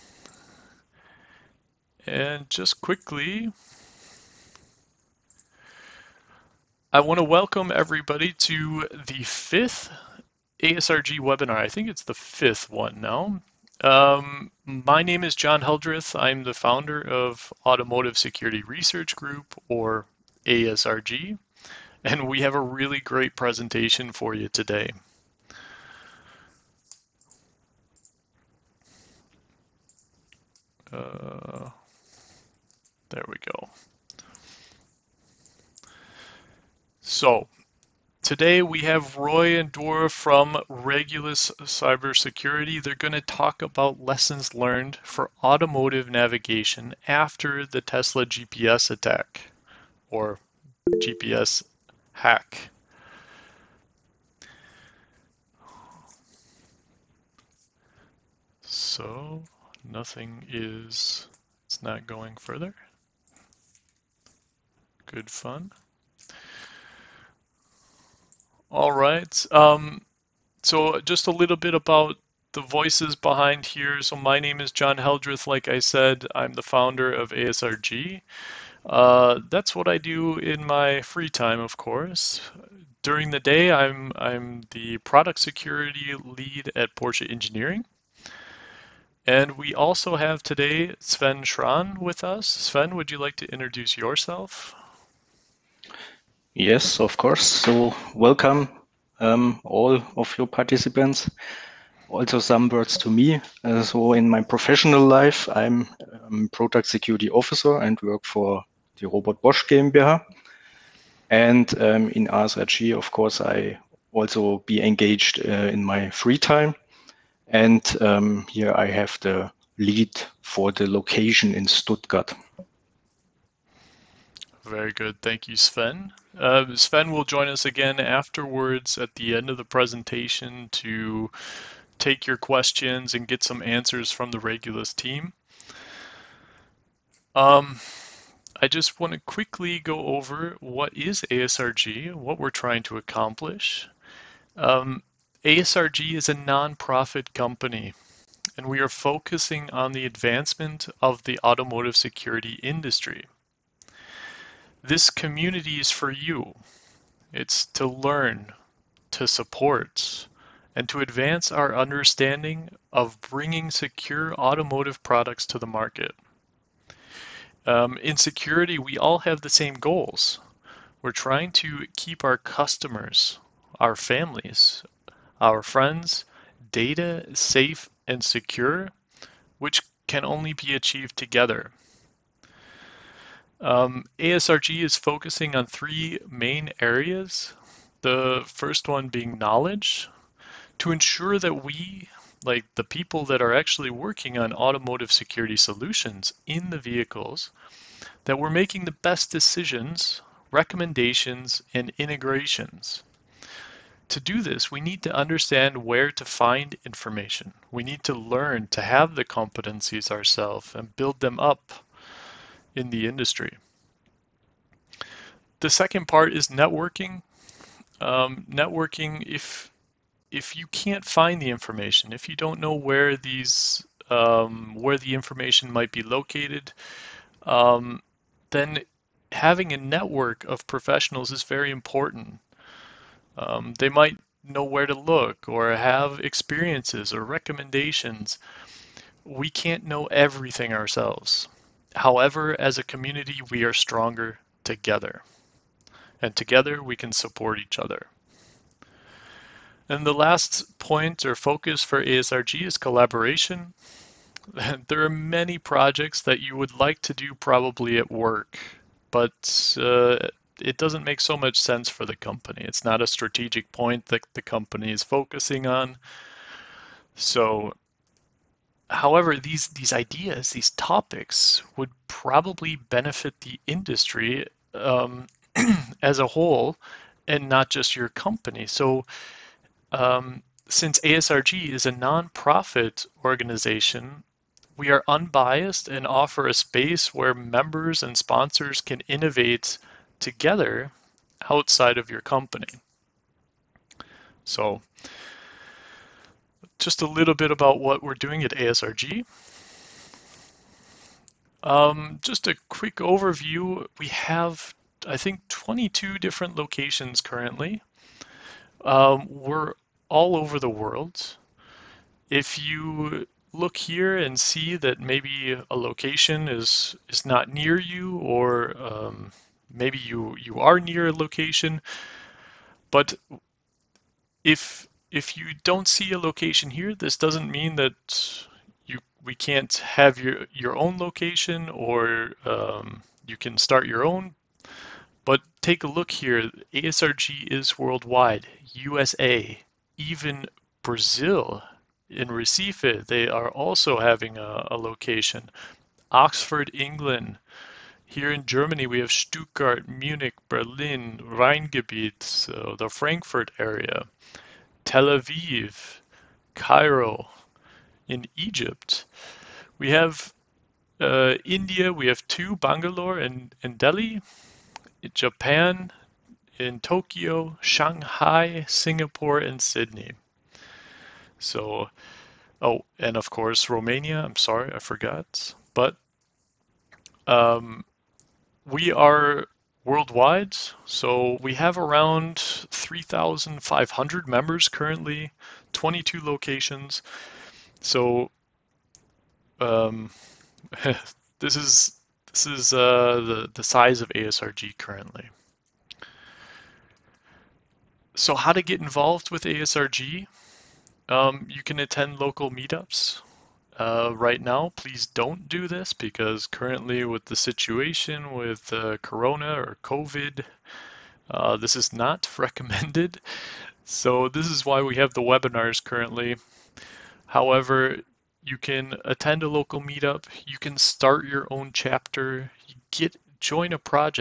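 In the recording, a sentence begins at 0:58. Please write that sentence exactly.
So, nothing is, it's not going further.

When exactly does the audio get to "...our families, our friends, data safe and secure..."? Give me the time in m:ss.
2:53.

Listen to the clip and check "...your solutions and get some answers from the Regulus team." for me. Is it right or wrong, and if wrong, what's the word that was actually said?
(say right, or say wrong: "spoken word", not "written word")
wrong: "questions", not "solutions".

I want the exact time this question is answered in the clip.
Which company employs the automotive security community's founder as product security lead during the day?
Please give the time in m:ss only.
1:26.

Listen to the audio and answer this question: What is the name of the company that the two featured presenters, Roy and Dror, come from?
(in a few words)
Regulus Cybersecurity.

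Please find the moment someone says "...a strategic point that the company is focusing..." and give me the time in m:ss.
4:23.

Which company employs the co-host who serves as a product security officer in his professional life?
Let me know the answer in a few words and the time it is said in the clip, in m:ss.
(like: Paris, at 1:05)
Robert Bosch GmbH, at 1:49.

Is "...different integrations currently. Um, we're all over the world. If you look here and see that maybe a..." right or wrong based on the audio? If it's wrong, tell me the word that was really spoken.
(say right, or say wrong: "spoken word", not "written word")
wrong: "locations", not "integrations".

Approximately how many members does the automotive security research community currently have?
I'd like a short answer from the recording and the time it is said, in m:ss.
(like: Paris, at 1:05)
3,500, at 6:22.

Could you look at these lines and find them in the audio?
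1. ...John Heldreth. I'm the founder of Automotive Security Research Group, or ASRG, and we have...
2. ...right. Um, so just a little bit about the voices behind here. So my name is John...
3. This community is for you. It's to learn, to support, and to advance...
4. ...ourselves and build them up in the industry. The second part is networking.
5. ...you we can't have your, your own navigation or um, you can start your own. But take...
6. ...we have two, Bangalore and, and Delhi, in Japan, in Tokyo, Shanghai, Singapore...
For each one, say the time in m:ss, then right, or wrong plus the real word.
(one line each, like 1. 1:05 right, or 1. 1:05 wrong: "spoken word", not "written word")
1. 0:15 right
2. 1:08 right
3. 2:34 right
4. 3:30 right
5. 5:28 wrong: "location", not "navigation"
6. 6:01 right.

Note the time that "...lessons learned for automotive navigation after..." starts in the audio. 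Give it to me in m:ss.
0:43.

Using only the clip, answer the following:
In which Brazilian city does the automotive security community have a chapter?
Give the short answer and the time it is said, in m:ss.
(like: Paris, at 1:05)
Recife, at 5:42.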